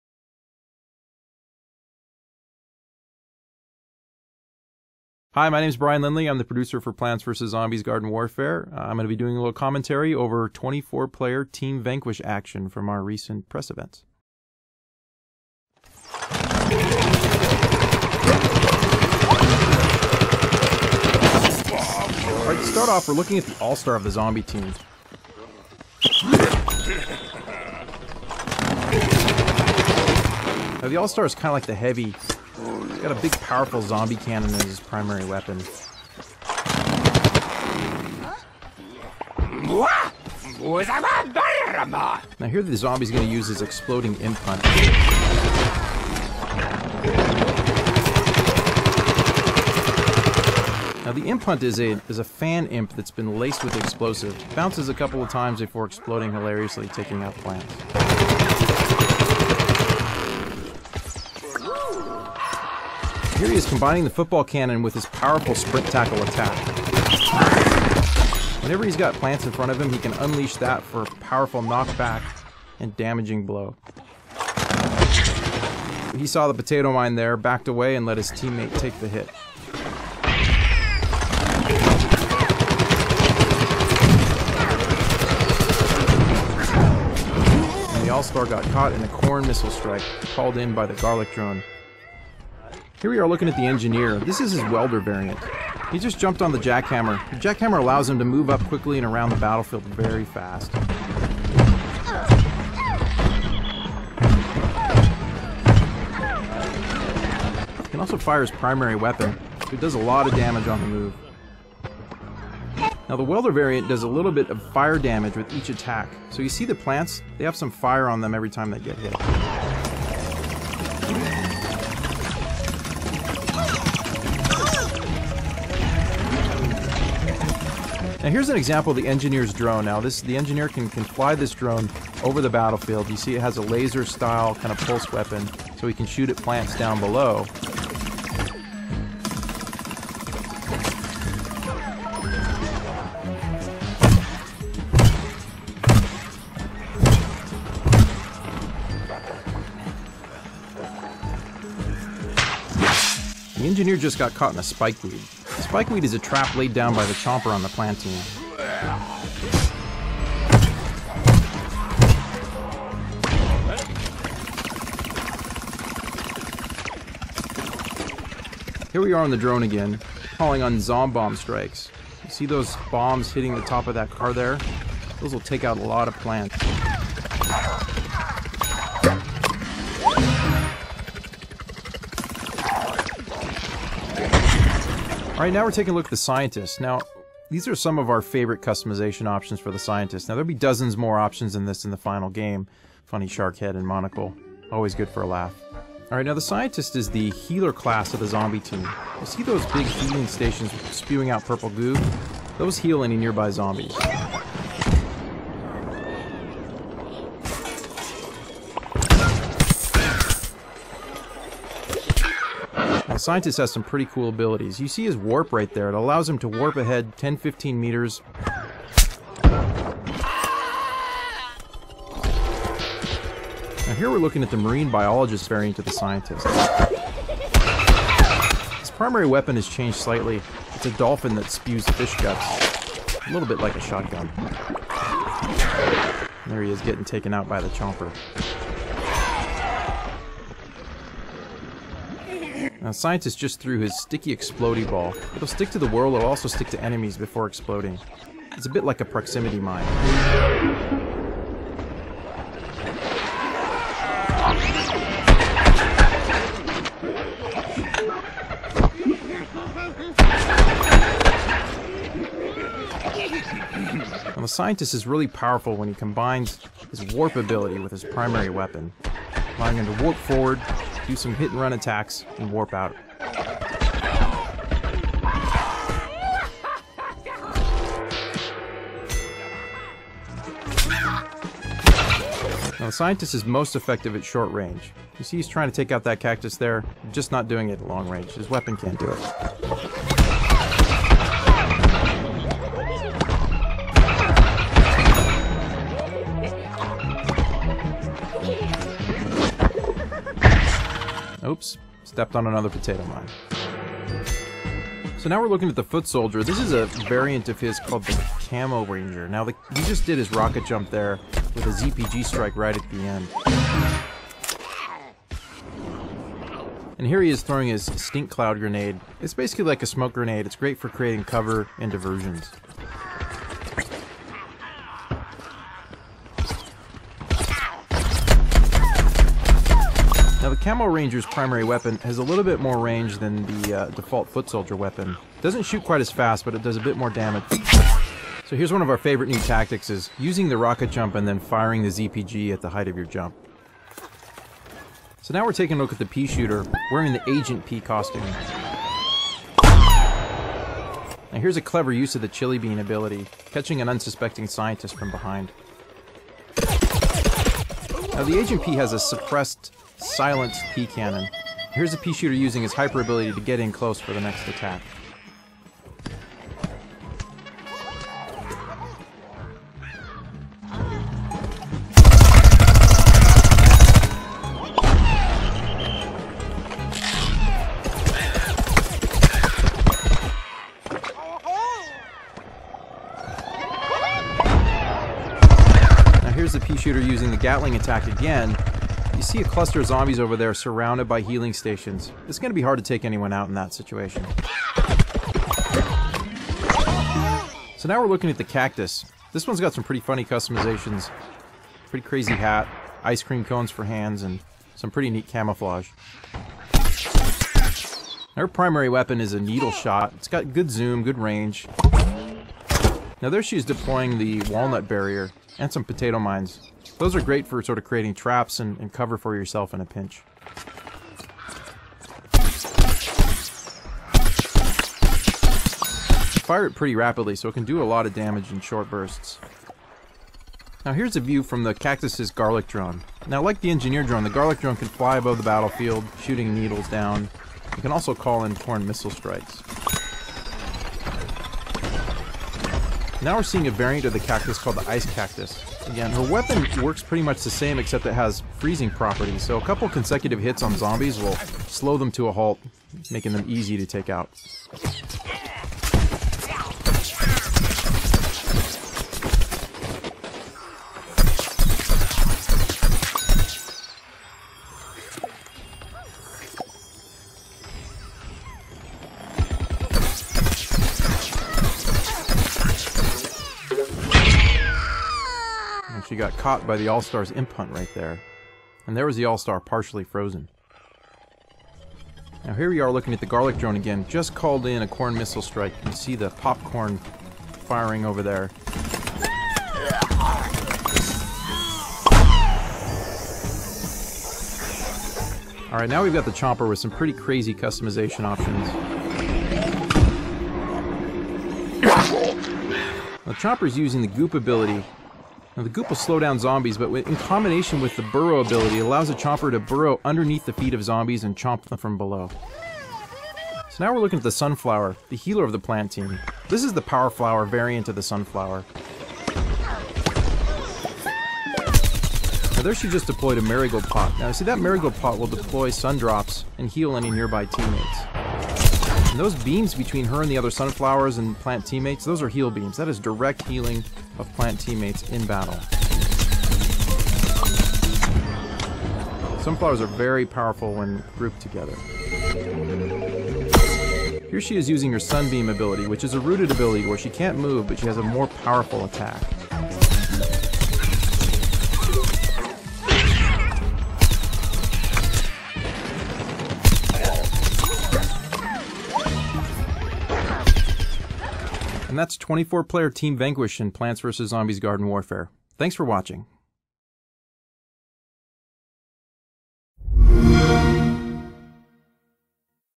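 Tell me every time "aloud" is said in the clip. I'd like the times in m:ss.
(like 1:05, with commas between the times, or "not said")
not said.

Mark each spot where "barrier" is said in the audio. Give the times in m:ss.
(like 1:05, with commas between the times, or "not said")
6:54.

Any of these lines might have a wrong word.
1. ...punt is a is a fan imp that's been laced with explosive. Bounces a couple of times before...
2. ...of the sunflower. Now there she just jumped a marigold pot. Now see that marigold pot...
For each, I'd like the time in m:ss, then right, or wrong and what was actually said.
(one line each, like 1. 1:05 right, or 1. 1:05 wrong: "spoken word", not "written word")
1. 0:51 right
2. 8:37 wrong: "deployed", not "jumped".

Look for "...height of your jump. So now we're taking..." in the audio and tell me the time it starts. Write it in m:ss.
5:42.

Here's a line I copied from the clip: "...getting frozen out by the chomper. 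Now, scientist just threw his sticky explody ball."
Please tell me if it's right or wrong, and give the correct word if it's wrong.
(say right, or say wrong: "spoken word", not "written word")
wrong: "taken", not "frozen".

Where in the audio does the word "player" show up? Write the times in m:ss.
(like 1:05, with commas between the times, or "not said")
0:11, 9:22.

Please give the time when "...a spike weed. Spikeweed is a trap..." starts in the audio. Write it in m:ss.
2:34.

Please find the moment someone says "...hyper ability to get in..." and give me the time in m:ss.
6:02.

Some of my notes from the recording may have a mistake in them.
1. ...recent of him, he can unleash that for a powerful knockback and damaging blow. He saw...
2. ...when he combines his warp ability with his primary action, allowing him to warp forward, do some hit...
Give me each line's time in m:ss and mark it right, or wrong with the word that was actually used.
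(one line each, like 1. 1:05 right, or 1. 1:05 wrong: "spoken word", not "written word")
1. 1:09 wrong: "front", not "recent"
2. 4:25 wrong: "weapon", not "action".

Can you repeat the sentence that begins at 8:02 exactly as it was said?
Now here we are looking at the garlic drone again.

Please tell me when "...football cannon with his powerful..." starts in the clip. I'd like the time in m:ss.
1:04.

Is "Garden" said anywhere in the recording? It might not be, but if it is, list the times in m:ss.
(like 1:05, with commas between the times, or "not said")
0:07, 9:24.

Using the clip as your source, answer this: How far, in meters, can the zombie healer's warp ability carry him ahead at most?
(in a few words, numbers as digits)
15 meters.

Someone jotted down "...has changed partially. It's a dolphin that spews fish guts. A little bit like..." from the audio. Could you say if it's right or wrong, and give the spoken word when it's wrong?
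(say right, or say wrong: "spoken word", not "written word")
wrong: "slightly", not "partially".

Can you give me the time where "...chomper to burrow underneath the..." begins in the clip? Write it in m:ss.
8:29.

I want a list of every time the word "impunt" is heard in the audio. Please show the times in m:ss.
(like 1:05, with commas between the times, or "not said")
7:57.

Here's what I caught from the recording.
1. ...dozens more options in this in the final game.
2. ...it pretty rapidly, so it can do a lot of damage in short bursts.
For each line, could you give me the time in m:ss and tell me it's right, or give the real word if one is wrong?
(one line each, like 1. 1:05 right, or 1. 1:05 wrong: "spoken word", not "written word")
1. 3:10 right
2. 7:06 right.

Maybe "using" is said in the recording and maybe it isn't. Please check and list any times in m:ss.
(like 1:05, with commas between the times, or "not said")
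5:40, 6:02, 6:26, 8:23, 9:04.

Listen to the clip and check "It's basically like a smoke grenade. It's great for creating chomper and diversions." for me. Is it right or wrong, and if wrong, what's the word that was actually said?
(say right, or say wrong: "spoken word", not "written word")
wrong: "cover", not "chomper".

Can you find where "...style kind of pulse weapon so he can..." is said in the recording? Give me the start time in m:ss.
2:14.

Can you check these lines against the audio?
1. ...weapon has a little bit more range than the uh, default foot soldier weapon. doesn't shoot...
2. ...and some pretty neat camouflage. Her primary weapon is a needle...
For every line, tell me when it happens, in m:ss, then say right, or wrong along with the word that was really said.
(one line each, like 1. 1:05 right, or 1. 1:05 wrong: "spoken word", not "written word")
1. 5:31 right
2. 6:44 right.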